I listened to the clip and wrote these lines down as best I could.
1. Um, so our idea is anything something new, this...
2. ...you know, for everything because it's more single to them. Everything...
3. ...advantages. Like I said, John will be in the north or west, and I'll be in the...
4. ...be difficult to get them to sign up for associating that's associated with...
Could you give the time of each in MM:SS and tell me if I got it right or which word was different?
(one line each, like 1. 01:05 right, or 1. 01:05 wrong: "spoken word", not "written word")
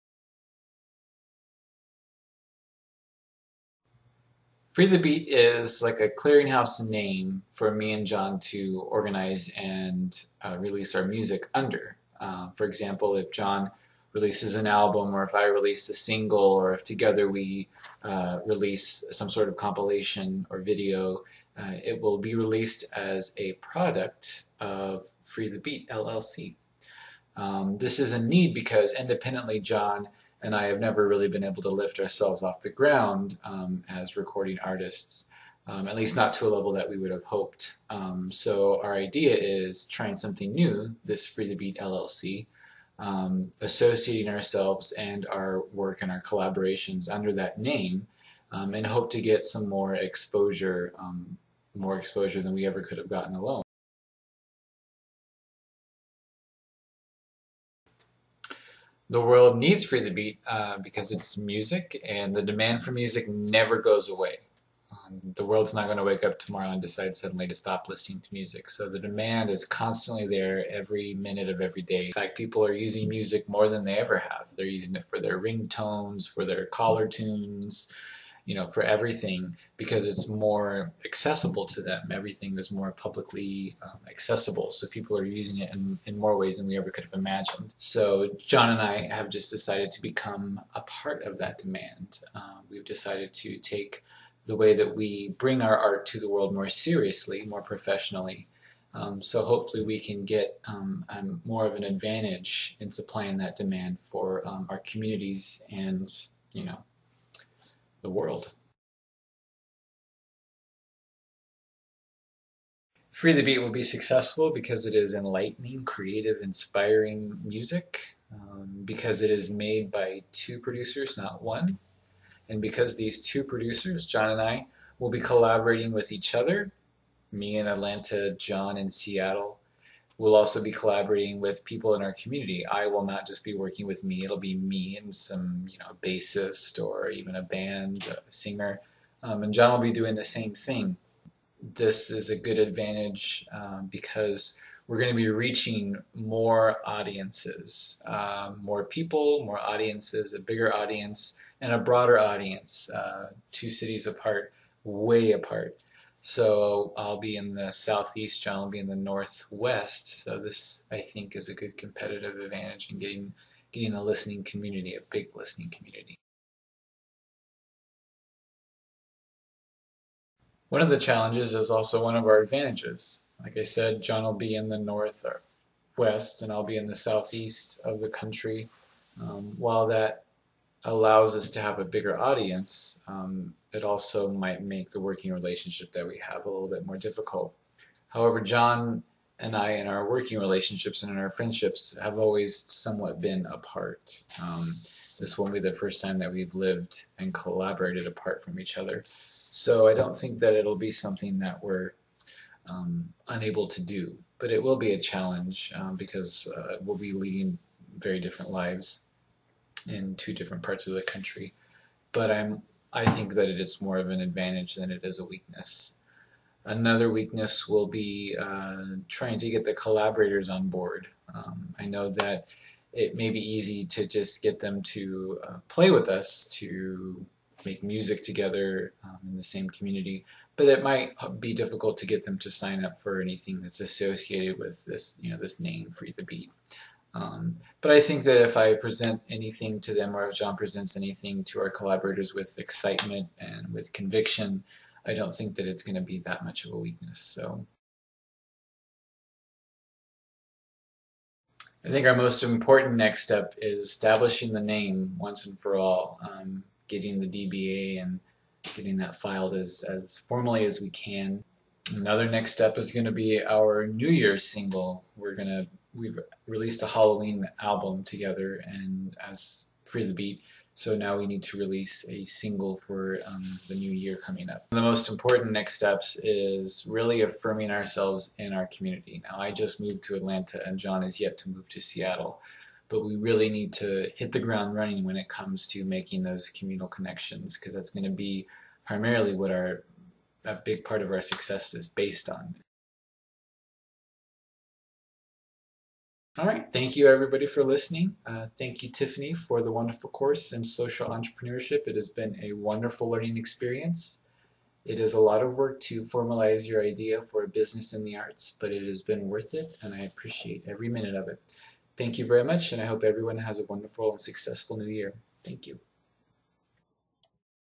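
1. 00:37 wrong: "trying", not "anything"
2. 01:18 wrong: "accessible", not "single"
3. 02:52 right
4. 03:51 wrong: "anything", not "associating".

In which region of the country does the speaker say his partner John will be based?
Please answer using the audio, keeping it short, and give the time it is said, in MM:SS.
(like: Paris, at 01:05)
Northwest, at 02:38.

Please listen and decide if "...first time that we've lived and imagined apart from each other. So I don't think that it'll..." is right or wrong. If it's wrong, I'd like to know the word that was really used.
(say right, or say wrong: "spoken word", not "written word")
wrong: "collaborated", not "imagined".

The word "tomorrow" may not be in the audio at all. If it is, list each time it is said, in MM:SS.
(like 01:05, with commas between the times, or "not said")
01:06.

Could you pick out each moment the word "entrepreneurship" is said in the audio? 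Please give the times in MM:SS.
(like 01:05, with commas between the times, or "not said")
05:01.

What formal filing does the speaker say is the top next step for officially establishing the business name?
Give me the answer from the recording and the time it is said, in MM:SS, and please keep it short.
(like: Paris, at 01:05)
DBA, at 04:17.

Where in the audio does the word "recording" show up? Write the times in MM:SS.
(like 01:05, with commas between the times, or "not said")
00:34.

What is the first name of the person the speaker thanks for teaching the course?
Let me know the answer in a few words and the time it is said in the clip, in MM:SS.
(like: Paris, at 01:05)
Tiffany, at 04:58.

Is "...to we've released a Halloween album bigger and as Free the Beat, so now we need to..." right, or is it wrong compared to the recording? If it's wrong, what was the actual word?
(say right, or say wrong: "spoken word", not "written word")
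wrong: "together", not "bigger".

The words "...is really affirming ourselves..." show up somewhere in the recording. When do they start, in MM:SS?
04:36.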